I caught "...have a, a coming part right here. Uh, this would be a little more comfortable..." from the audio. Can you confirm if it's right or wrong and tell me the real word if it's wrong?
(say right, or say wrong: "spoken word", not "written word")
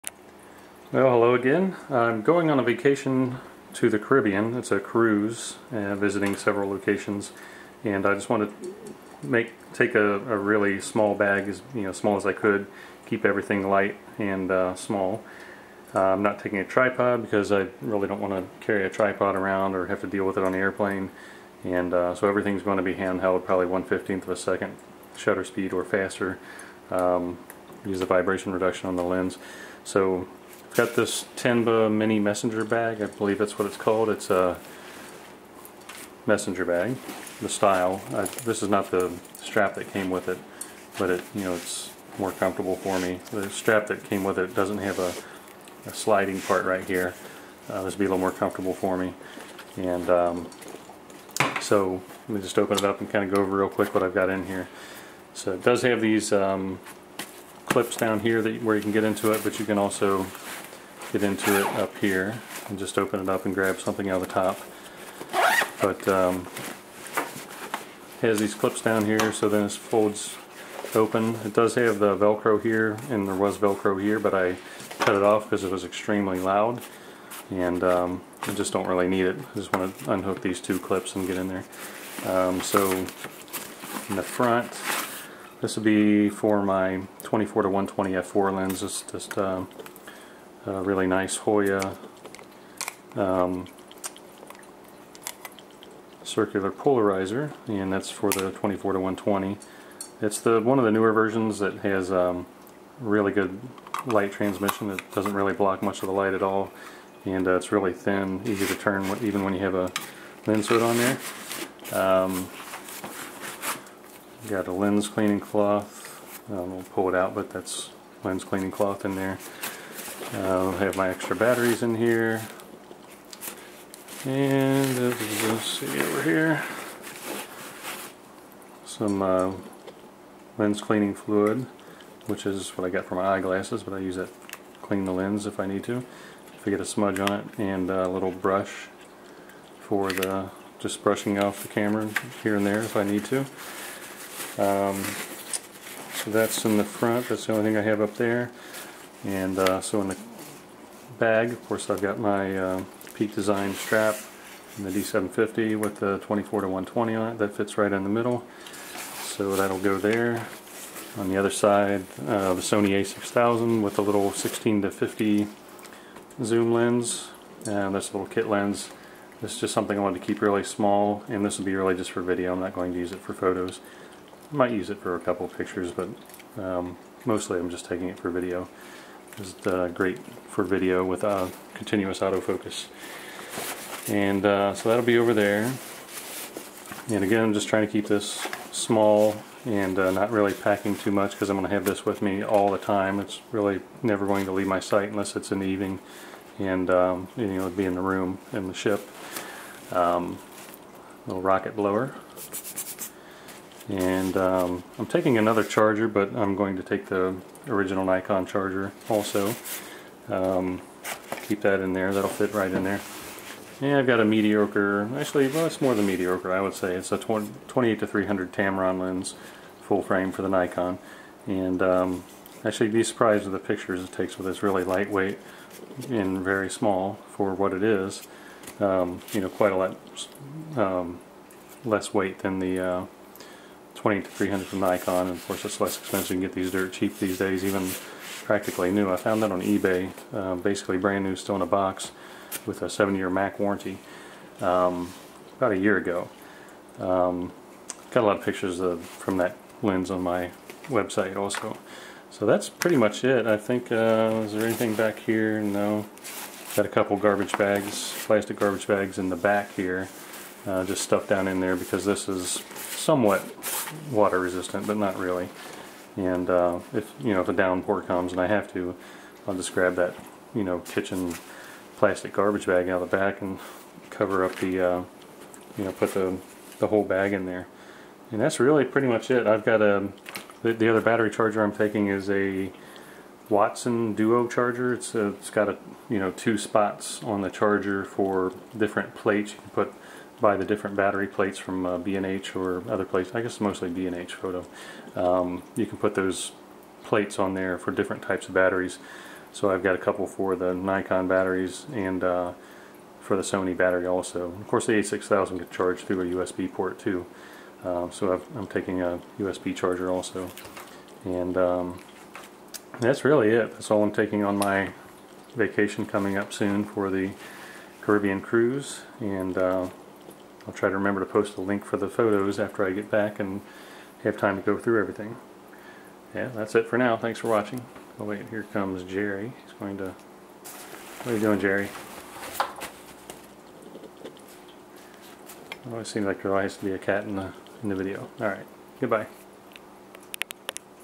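wrong: "sliding", not "coming".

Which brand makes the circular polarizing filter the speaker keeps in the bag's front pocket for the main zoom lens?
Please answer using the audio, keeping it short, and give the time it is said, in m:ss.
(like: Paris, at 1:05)
Hoya, at 1:31.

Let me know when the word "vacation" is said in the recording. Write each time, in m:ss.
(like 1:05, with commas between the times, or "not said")
0:02, 5:15.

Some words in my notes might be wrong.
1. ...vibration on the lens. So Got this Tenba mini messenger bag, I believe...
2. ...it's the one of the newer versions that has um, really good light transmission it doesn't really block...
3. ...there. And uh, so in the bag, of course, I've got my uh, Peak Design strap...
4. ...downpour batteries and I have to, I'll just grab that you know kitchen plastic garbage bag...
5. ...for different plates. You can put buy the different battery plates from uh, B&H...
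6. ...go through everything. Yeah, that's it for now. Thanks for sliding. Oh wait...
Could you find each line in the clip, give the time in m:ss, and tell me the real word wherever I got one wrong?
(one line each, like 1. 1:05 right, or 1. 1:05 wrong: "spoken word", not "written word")
1. 0:28 wrong: "reduction", not "vibration"
2. 1:40 right
3. 2:28 right
4. 4:27 wrong: "comes", not "batteries"
5. 4:48 right
6. 5:24 wrong: "watching", not "sliding".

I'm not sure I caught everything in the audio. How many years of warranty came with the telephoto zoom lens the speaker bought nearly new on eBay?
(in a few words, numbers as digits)
7.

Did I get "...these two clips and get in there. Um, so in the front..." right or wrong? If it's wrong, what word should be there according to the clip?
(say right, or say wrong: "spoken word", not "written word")
right.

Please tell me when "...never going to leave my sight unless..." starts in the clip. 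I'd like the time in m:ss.
3:14.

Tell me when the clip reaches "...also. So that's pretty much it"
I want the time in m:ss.
4:11.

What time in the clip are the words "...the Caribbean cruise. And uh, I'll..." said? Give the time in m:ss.
5:17.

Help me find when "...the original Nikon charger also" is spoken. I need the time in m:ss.
3:27.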